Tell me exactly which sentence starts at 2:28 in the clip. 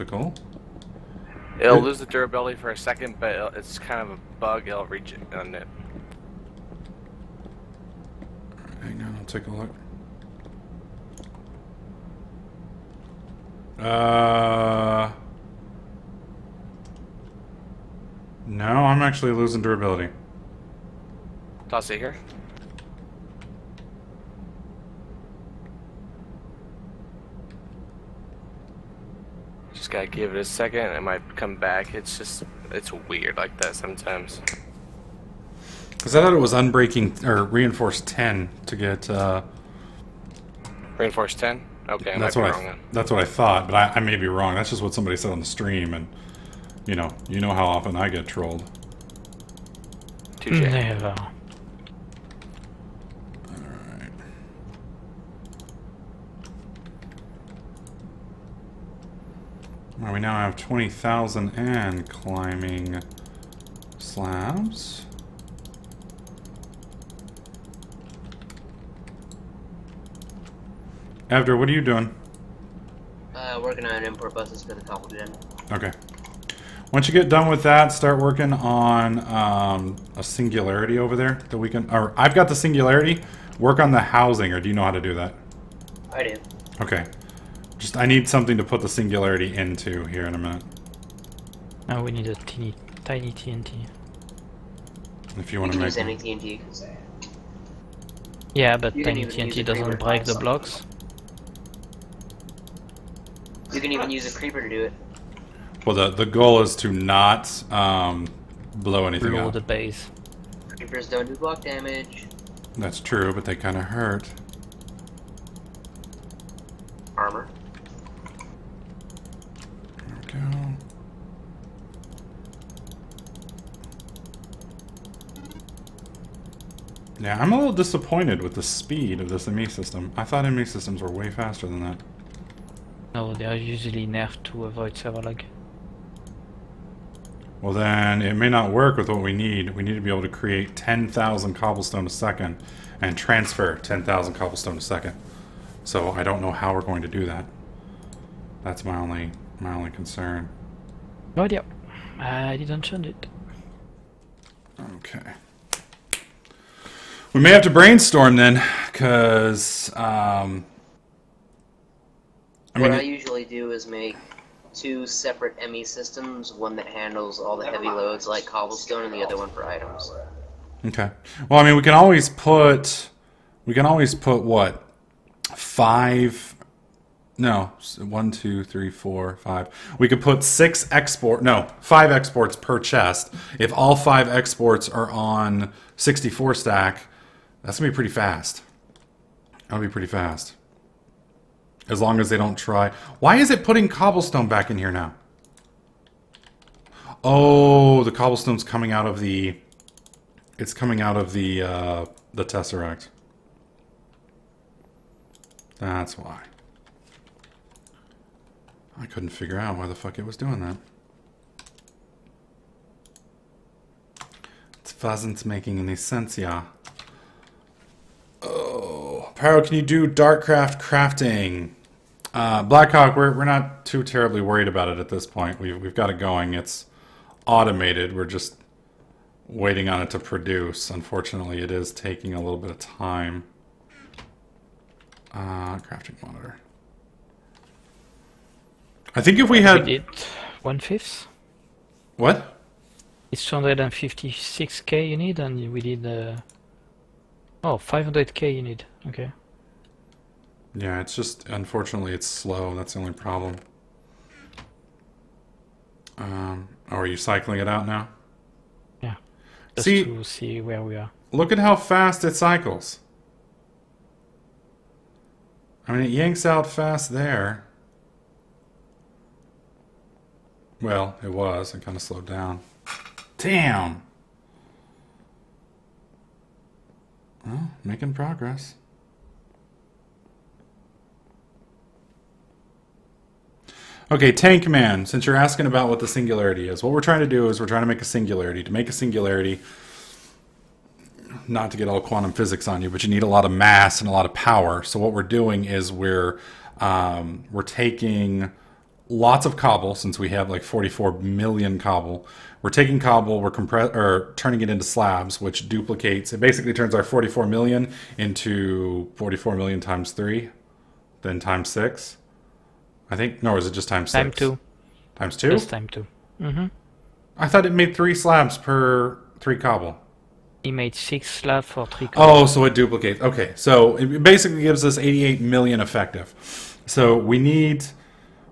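That's my only my only concern.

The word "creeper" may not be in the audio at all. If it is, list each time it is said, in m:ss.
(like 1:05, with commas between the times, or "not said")
1:44, 1:50.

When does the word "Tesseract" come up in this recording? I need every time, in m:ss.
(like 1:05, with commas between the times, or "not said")
3:22.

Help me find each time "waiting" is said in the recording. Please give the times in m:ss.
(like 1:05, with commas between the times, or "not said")
3:49.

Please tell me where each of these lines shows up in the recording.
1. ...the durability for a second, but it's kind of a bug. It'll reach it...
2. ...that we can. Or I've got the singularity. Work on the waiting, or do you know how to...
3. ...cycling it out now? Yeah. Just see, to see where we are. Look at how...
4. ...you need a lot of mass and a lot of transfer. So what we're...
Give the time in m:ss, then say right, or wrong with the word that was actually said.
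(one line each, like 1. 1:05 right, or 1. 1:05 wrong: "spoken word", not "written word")
1. 0:01 right
2. 1:21 wrong: "housing", not "waiting"
3. 4:17 right
4. 4:53 wrong: "power", not "transfer".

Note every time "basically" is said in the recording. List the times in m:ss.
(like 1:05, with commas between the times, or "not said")
5:06, 5:24.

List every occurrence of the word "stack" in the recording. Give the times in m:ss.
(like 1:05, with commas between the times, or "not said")
3:06.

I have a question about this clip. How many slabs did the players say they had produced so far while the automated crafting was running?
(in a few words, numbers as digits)
20,000.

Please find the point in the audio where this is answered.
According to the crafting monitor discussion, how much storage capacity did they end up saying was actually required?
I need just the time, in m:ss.
4:07.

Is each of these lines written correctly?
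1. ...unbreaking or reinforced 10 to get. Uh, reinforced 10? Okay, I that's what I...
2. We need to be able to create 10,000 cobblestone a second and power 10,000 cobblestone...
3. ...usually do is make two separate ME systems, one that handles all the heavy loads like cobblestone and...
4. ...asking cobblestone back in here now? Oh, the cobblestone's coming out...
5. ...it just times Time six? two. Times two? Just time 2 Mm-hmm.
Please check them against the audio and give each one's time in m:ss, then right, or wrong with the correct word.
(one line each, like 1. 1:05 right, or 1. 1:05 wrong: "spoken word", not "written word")
1. 0:36 right
2. 2:19 wrong: "transfer", not "power"
3. 2:43 right
4. 3:13 wrong: "putting", not "asking"
5. 5:13 right.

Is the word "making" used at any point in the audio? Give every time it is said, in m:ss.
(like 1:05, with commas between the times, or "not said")
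3:35, 4:37.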